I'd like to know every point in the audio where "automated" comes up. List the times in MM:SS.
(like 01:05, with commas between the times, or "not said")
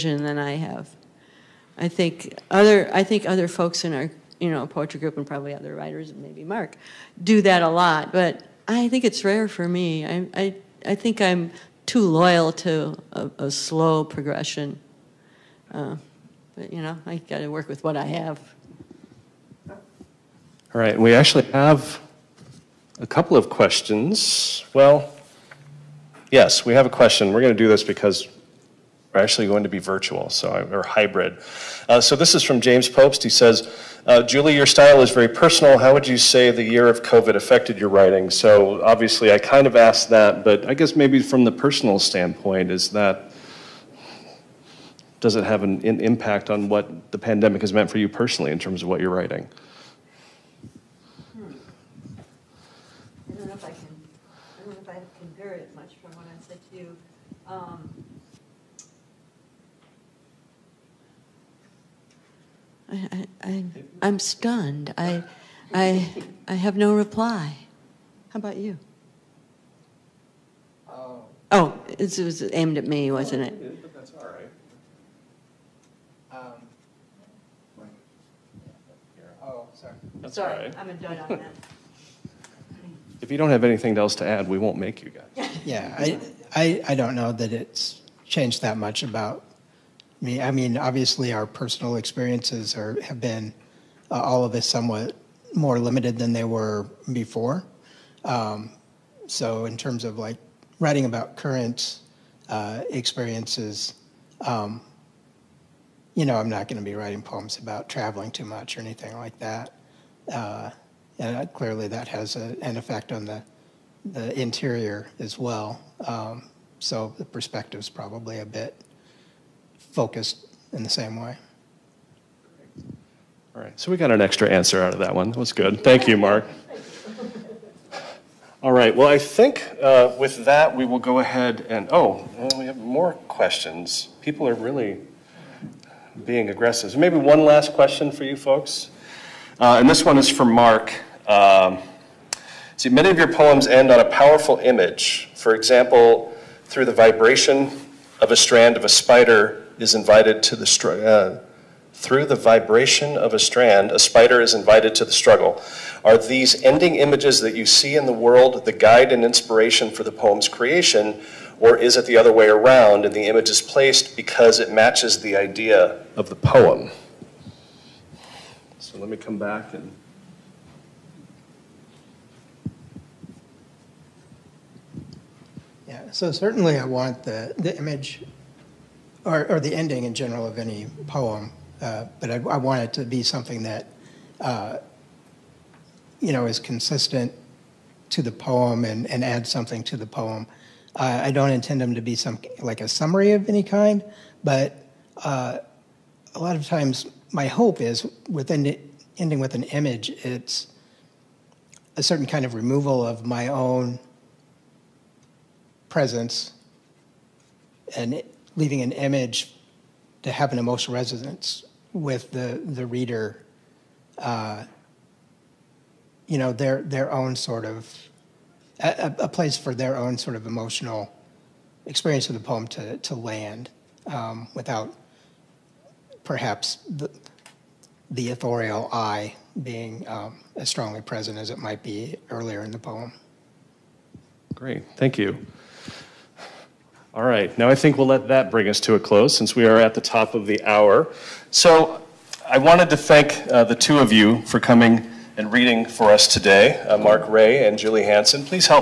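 not said.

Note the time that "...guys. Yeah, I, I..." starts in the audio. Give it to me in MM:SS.
01:25.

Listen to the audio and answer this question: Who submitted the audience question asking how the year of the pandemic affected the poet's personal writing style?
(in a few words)
James Popes.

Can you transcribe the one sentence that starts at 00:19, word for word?
All right, we actually have a couple of questions.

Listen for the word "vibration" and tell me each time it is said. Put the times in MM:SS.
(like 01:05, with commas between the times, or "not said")
02:26, 02:32.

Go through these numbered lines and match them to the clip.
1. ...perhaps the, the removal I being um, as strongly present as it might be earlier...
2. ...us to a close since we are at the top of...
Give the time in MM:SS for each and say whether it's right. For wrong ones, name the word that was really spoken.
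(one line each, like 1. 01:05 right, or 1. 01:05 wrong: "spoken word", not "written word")
1. 03:46 wrong: "authorial", not "removal"
2. 03:58 right.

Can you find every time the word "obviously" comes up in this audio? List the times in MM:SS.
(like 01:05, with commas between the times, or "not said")
00:38, 01:30.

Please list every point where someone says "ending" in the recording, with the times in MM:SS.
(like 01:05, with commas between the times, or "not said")
02:36, 02:59, 03:19.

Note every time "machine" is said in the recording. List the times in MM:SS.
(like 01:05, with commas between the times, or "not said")
not said.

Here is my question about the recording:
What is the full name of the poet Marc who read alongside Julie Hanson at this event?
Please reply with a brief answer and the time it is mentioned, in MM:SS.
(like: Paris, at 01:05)
Marc Rahe, at 04:06.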